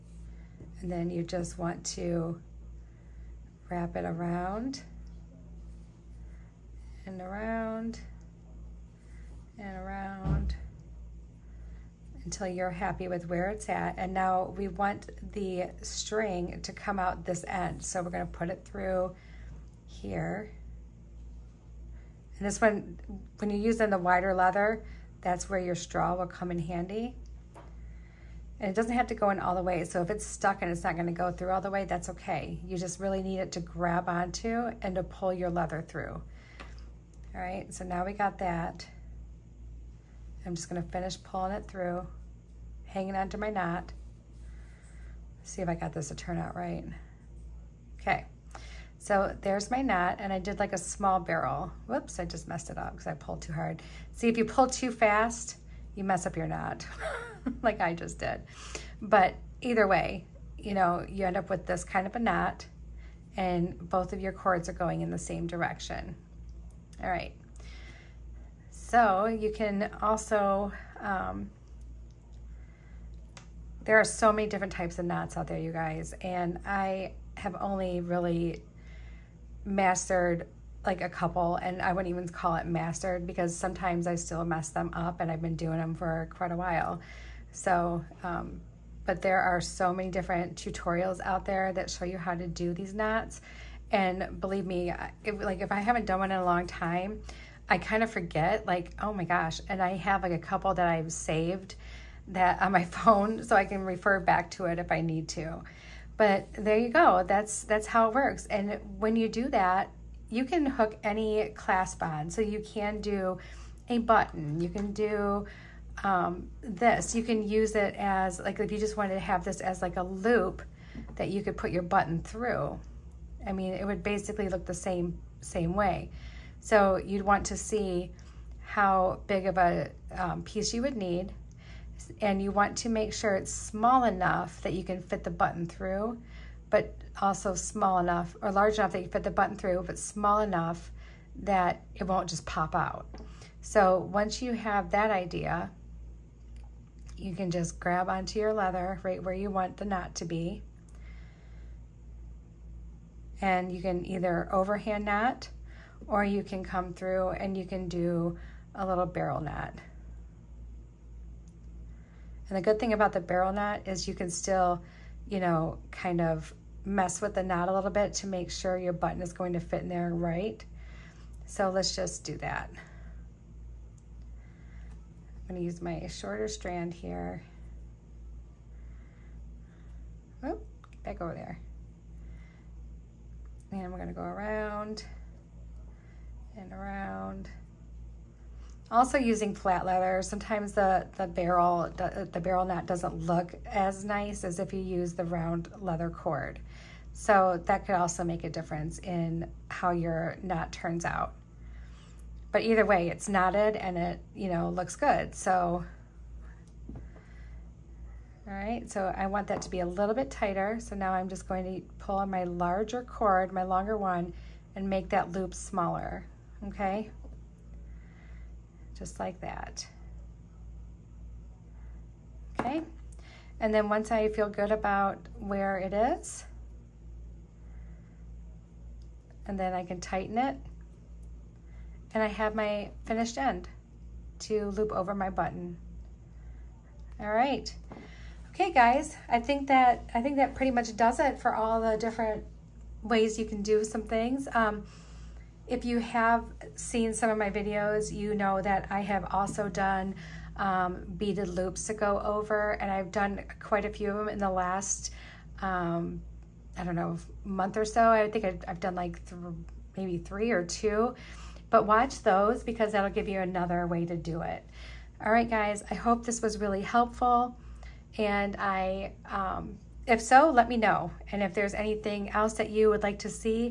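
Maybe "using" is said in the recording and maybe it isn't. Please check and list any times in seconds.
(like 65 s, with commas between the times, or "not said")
23 s, 189 s.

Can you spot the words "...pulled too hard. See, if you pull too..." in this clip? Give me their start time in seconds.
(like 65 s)
53 s.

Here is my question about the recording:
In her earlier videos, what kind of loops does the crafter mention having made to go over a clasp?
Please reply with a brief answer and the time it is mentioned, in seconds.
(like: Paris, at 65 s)
beaded loops, at 251 s.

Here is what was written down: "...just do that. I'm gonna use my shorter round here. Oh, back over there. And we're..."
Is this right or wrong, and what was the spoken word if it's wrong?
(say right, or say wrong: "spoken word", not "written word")
wrong: "strand", not "round".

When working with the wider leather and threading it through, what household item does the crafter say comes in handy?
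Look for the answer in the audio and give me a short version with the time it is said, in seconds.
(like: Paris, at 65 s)
straw, at 25 s.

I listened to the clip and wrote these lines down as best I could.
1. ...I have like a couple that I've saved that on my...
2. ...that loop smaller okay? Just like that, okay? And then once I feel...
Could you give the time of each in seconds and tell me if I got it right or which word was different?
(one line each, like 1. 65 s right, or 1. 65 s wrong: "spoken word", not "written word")
1. 99 s right
2. 215 s right.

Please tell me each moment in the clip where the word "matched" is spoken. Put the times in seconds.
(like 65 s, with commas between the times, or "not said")
not said.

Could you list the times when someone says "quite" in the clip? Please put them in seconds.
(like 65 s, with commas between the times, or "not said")
86 s, 253 s.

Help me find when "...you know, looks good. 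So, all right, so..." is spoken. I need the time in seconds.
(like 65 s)
204 s.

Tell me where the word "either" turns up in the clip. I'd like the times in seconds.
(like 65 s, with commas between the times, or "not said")
59 s, 154 s, 202 s.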